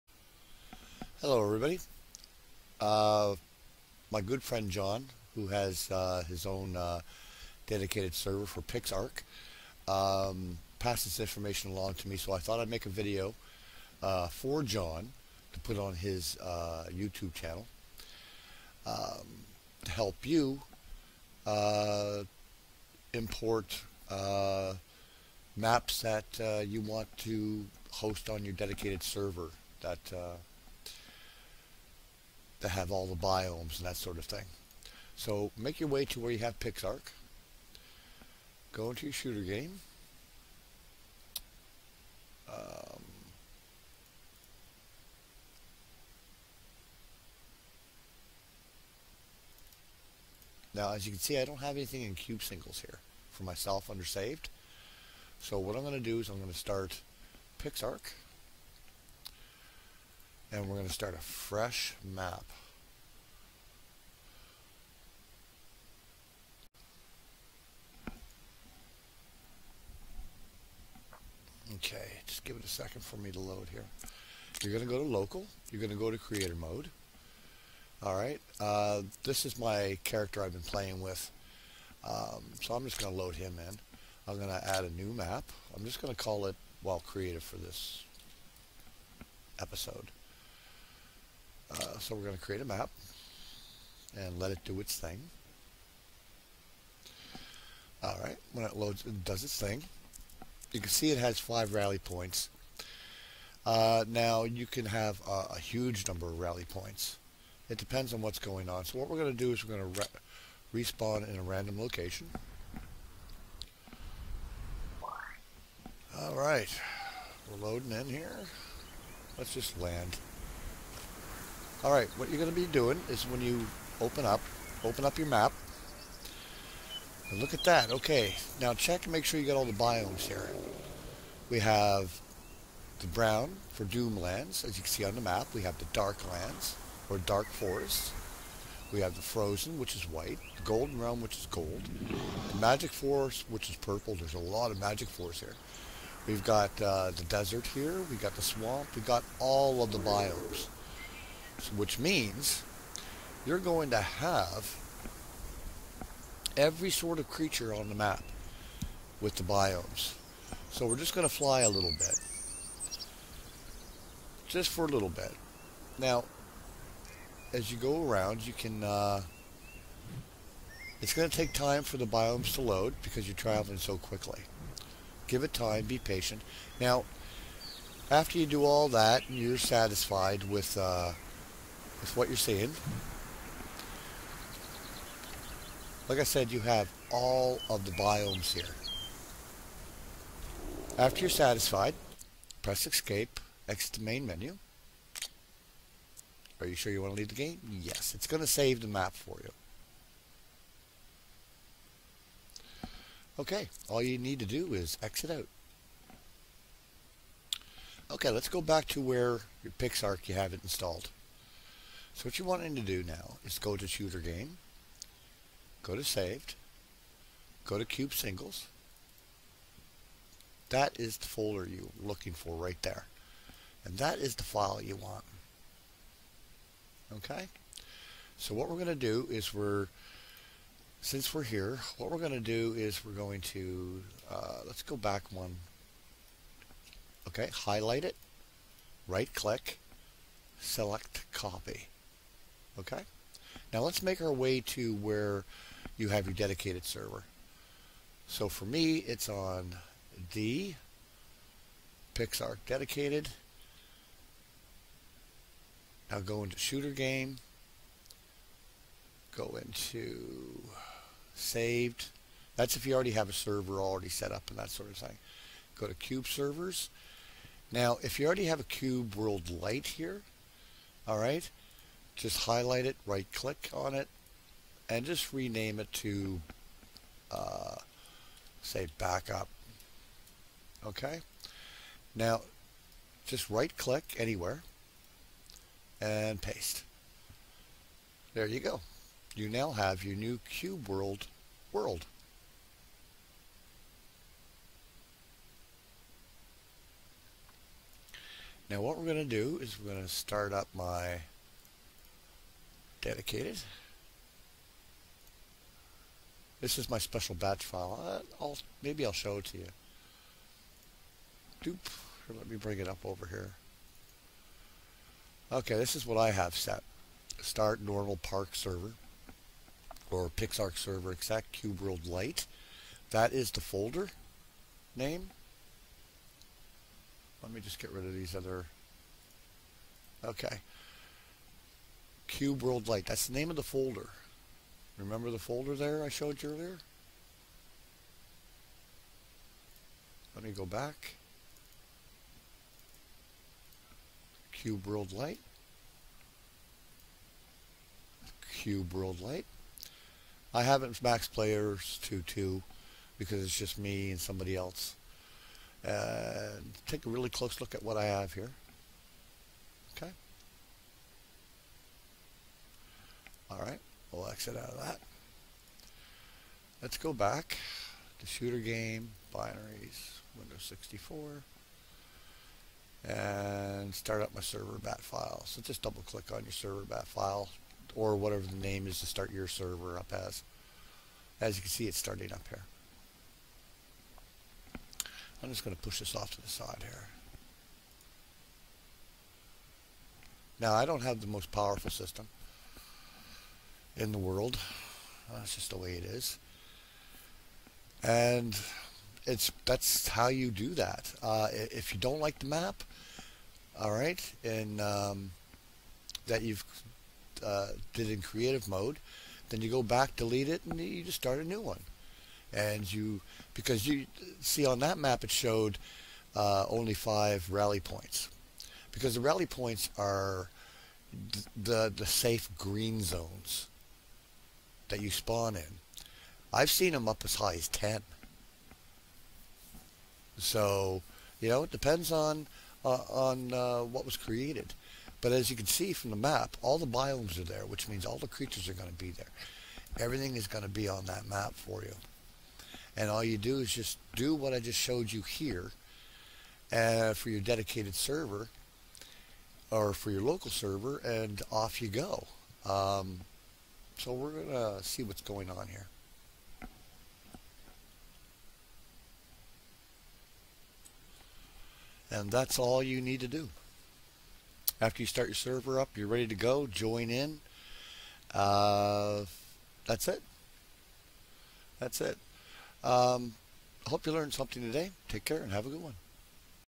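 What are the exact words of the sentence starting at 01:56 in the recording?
All right, we're loading in here.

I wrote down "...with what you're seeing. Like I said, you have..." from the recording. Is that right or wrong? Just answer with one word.
right.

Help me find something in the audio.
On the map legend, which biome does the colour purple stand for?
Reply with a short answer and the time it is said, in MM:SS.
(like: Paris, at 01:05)
Magic forest, at 02:22.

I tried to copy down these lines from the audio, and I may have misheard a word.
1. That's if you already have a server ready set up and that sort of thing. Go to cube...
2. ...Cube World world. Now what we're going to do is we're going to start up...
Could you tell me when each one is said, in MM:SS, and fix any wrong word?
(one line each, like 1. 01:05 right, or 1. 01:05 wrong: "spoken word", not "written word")
1. 04:22 wrong: "already", not "ready"
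2. 04:50 right.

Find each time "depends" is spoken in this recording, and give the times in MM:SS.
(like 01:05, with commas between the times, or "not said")
01:47, 07:11.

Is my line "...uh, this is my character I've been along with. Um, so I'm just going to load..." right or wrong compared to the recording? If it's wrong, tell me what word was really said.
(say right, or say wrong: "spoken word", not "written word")
wrong: "playing", not "along".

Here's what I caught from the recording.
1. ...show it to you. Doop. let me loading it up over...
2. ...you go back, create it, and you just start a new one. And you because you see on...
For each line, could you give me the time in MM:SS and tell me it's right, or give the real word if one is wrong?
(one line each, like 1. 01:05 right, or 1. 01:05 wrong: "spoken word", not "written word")
1. 05:09 wrong: "bring", not "loading"
2. 06:49 wrong: "delete", not "create".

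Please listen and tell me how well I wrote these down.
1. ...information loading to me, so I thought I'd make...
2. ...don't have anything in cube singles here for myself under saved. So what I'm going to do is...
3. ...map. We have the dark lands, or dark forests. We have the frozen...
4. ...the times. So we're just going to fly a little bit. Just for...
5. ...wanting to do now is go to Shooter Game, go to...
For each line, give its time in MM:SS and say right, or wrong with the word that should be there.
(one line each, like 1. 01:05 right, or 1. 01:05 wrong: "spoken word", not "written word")
1. 00:11 wrong: "along", not "loading"
2. 00:51 right
3. 02:15 right
4. 02:39 wrong: "biomes", not "times"
5. 03:32 right.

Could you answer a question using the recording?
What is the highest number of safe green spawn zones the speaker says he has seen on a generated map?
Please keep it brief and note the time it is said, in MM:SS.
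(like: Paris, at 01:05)
10, at 07:07.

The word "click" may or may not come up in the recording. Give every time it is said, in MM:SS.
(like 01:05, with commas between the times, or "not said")
03:59, 04:33, 04:43, 06:16.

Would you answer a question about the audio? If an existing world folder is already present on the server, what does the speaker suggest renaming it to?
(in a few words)
Backup.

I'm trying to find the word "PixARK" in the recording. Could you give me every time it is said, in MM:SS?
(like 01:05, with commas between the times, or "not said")
00:08, 00:36, 00:57, 03:29, 04:12, 05:20.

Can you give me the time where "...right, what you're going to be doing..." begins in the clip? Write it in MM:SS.
02:01.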